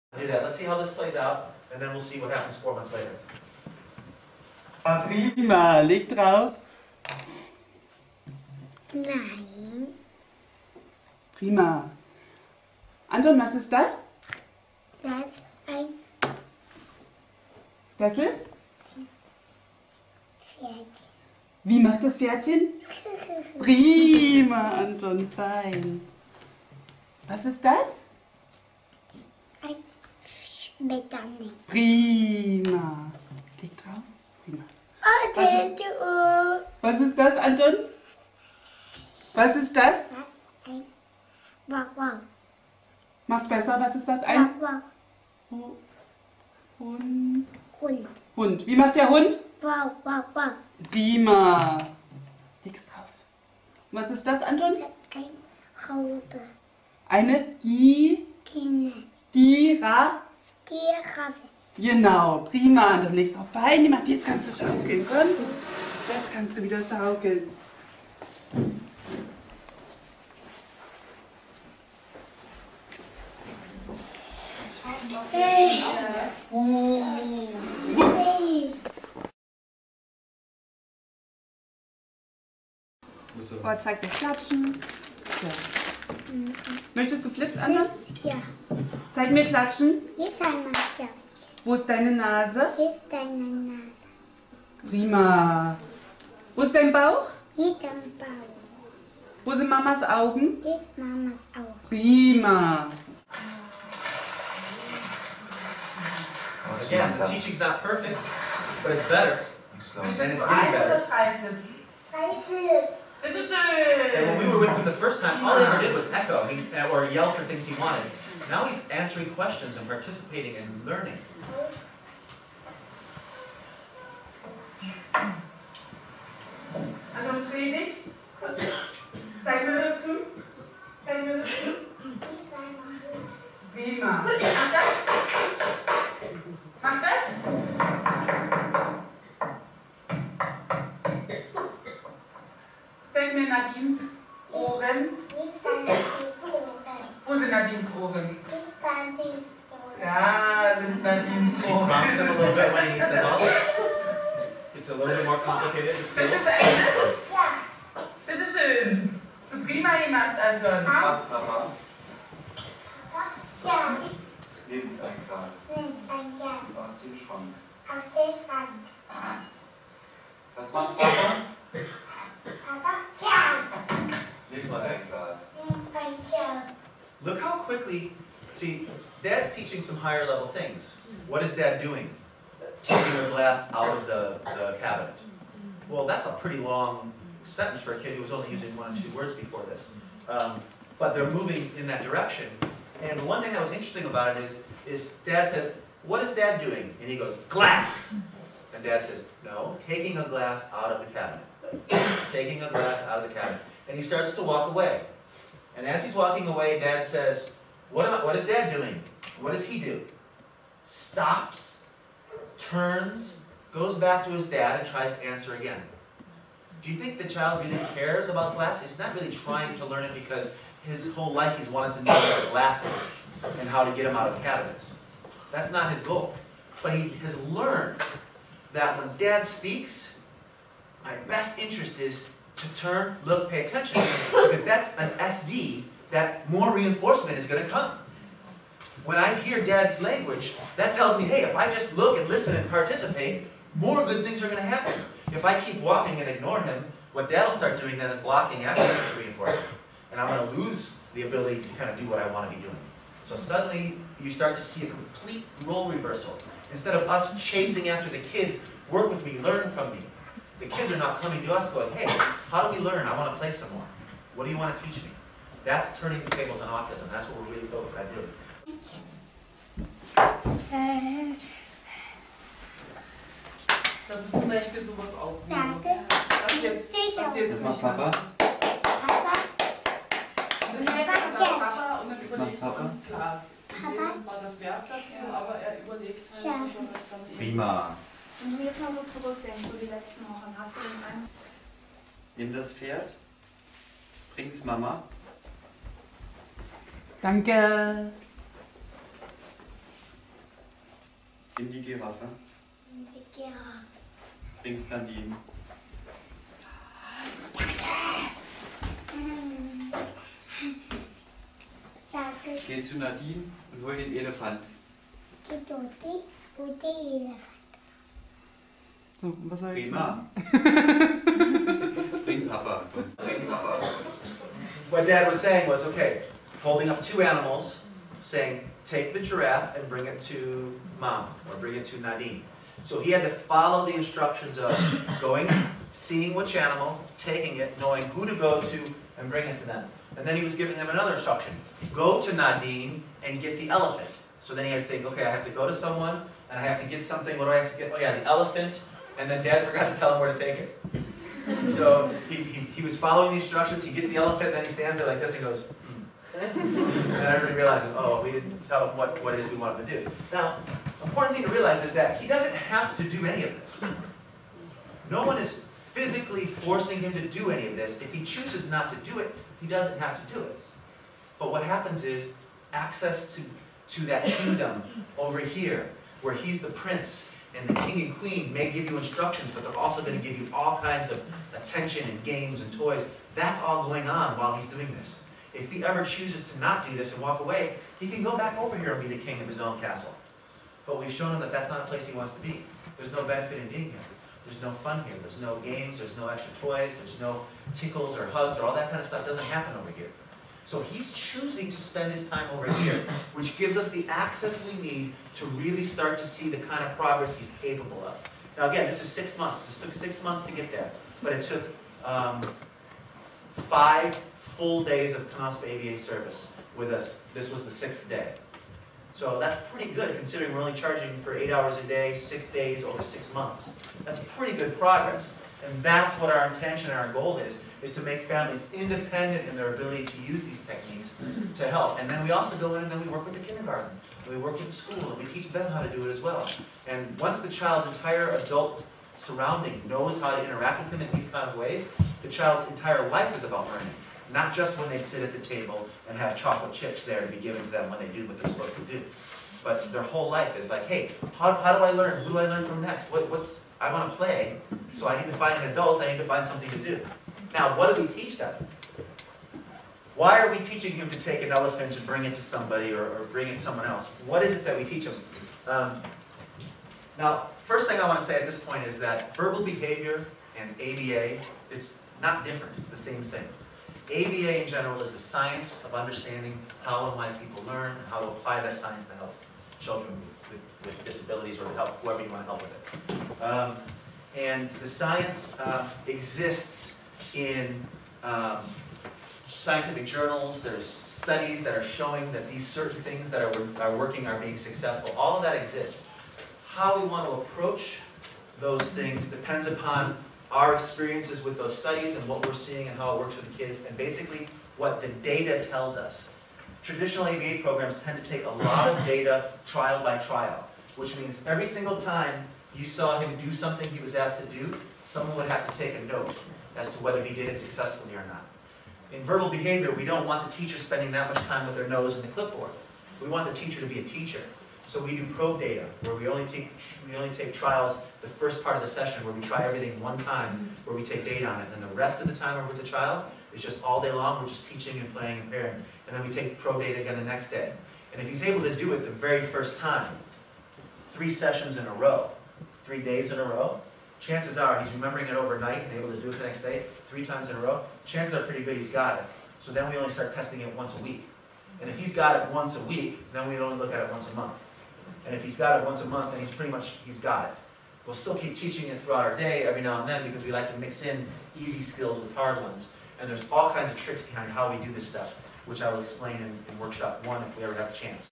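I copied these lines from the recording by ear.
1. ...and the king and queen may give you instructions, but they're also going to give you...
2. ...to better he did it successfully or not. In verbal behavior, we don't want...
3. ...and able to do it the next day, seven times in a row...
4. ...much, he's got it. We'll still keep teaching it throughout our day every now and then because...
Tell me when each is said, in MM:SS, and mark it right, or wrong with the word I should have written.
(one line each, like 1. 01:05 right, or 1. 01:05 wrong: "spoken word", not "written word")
1. 06:17 right
2. 08:36 wrong: "whether", not "better"
3. 09:05 wrong: "three", not "seven"
4. 09:16 right.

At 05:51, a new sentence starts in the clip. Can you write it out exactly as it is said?
So he, he, he, was following the instructions, he gets the elephant, and then he stands there like this and goes, hmm.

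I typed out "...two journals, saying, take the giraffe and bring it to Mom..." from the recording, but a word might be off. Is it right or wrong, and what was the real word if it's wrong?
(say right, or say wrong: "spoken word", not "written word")
wrong: "animals", not "journals".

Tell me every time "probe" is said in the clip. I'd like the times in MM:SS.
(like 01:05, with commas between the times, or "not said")
08:45, 08:56.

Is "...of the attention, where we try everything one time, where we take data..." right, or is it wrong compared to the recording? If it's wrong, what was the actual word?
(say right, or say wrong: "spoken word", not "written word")
wrong: "session", not "attention".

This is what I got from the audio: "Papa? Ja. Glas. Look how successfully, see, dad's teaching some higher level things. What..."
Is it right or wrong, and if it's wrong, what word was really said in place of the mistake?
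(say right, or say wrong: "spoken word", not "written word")
wrong: "quickly", not "successfully".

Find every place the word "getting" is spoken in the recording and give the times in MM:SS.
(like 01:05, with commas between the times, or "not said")
01:50.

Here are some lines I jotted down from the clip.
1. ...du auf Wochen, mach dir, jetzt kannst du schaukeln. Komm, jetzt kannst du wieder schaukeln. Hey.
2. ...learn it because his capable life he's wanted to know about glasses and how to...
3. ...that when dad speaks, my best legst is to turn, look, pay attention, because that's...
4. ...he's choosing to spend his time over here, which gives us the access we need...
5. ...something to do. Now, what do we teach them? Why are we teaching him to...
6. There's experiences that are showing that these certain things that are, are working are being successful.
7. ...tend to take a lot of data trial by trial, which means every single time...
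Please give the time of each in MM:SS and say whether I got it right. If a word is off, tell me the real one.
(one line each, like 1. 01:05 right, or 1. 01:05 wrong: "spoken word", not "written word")
1. 01:03 wrong: "Beine", not "Wochen"
2. 03:39 wrong: "whole", not "capable"
3. 03:48 wrong: "interest", not "legst"
4. 06:40 right
5. 07:36 right
6. 08:10 wrong: "studies", not "experiences"
7. 08:28 right.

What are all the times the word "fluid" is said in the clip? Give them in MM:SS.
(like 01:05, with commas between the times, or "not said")
not said.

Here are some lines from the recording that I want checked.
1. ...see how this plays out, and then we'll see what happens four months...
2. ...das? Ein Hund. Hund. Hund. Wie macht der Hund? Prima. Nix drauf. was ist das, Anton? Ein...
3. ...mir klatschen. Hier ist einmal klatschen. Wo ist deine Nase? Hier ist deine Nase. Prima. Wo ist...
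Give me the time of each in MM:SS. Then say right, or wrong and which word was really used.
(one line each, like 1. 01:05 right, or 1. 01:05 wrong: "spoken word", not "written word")
1. 00:00 right
2. 00:44 right
3. 01:29 right.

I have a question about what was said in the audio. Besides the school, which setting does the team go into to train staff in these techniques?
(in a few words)
Kindergarten.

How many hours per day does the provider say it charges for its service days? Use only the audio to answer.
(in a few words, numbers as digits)
8.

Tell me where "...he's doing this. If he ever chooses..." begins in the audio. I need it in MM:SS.
06:24.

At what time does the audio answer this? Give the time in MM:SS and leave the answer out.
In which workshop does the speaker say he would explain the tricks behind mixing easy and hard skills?
09:26.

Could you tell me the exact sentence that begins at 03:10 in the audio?
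Um, but they're moving in that direction.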